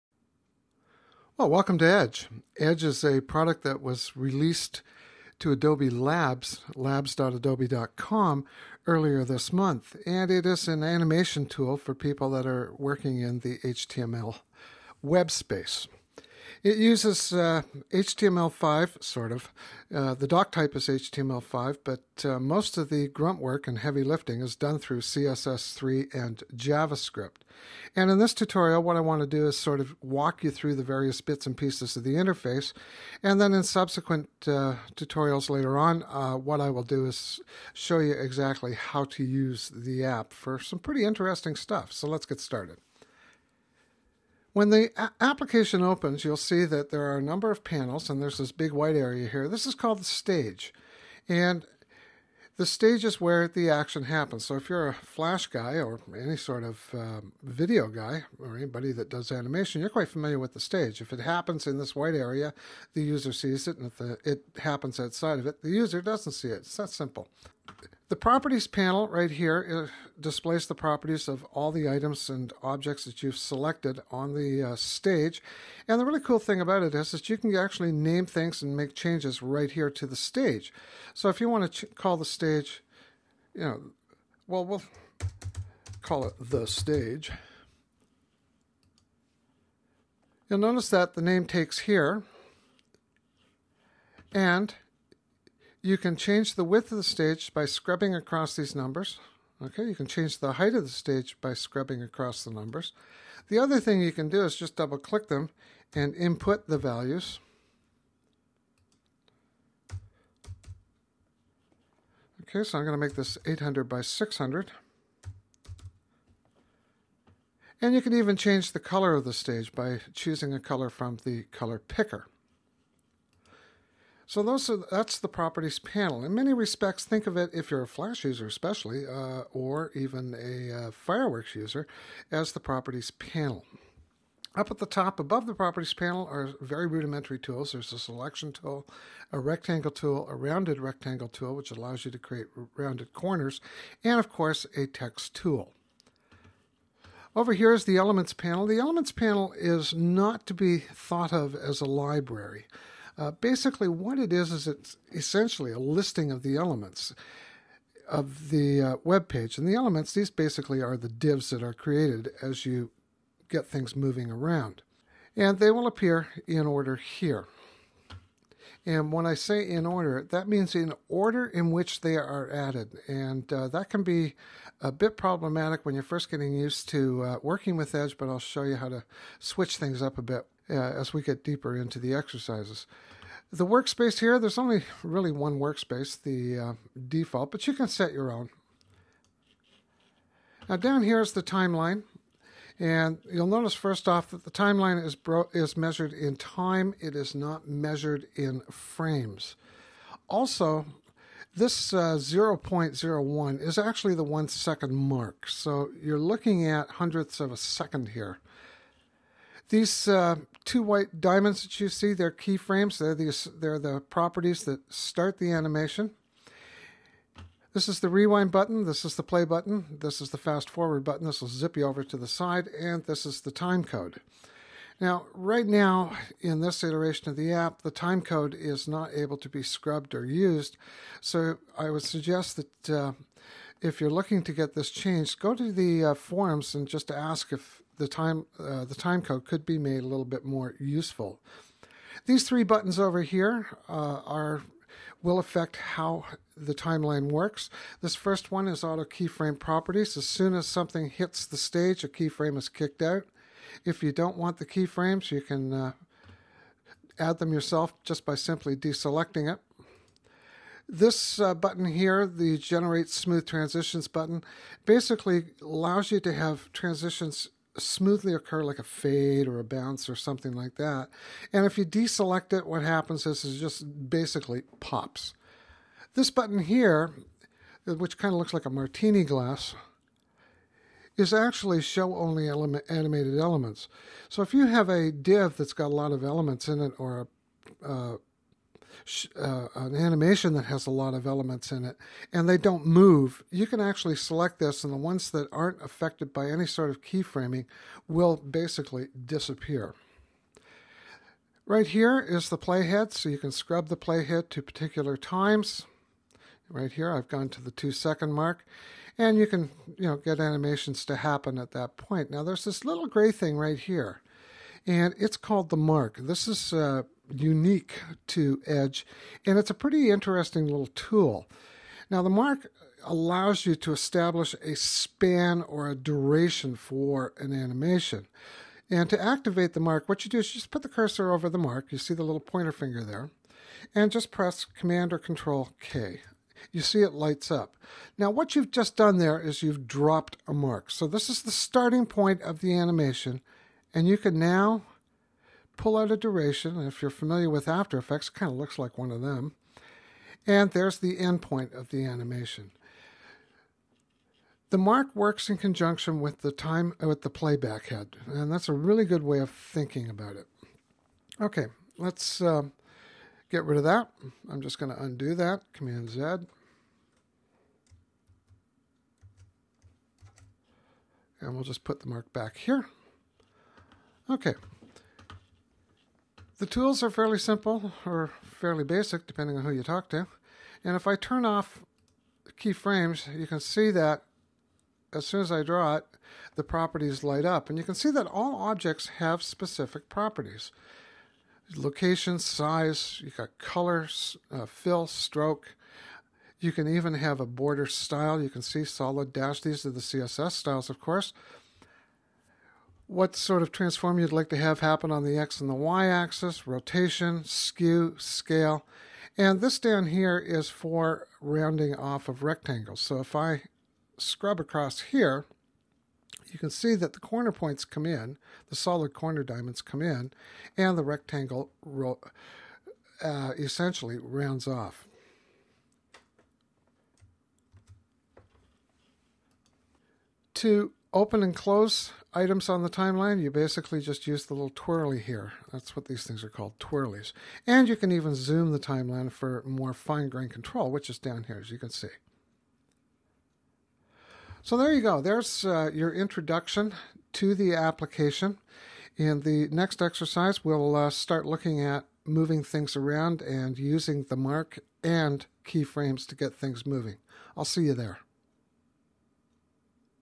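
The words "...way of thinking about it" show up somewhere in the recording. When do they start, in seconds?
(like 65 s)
359 s.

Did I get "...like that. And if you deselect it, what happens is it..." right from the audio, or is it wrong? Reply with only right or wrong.
right.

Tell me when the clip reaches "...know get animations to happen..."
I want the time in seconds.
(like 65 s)
310 s.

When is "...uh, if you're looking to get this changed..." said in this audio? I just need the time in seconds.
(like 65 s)
232 s.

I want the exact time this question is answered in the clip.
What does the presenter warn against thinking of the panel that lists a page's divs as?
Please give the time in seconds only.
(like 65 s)
151 s.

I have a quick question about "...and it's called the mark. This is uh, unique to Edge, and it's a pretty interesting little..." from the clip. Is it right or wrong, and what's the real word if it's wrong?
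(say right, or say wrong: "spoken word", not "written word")
right.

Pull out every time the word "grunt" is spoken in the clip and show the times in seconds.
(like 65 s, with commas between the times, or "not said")
23 s.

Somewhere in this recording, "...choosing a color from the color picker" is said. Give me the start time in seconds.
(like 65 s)
120 s.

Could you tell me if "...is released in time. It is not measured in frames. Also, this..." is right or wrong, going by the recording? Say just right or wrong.
wrong.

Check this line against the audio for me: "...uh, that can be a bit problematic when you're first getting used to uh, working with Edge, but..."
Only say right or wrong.
right.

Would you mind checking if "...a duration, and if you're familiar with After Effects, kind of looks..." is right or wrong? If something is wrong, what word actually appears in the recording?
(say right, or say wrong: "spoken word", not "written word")
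right.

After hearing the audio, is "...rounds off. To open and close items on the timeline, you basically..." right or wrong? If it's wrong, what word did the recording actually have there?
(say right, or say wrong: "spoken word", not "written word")
right.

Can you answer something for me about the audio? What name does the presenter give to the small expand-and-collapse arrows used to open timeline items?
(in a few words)
twirlies.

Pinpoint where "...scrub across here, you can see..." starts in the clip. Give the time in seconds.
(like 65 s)
414 s.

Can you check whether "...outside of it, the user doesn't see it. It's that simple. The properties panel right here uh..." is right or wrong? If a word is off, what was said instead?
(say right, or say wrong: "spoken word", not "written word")
right.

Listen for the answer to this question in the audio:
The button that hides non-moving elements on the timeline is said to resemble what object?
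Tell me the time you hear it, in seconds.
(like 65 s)
278 s.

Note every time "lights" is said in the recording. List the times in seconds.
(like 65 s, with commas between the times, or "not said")
337 s, 387 s.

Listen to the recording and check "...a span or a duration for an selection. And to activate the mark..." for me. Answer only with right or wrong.
wrong.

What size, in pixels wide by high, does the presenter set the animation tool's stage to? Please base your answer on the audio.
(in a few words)
800 by 600.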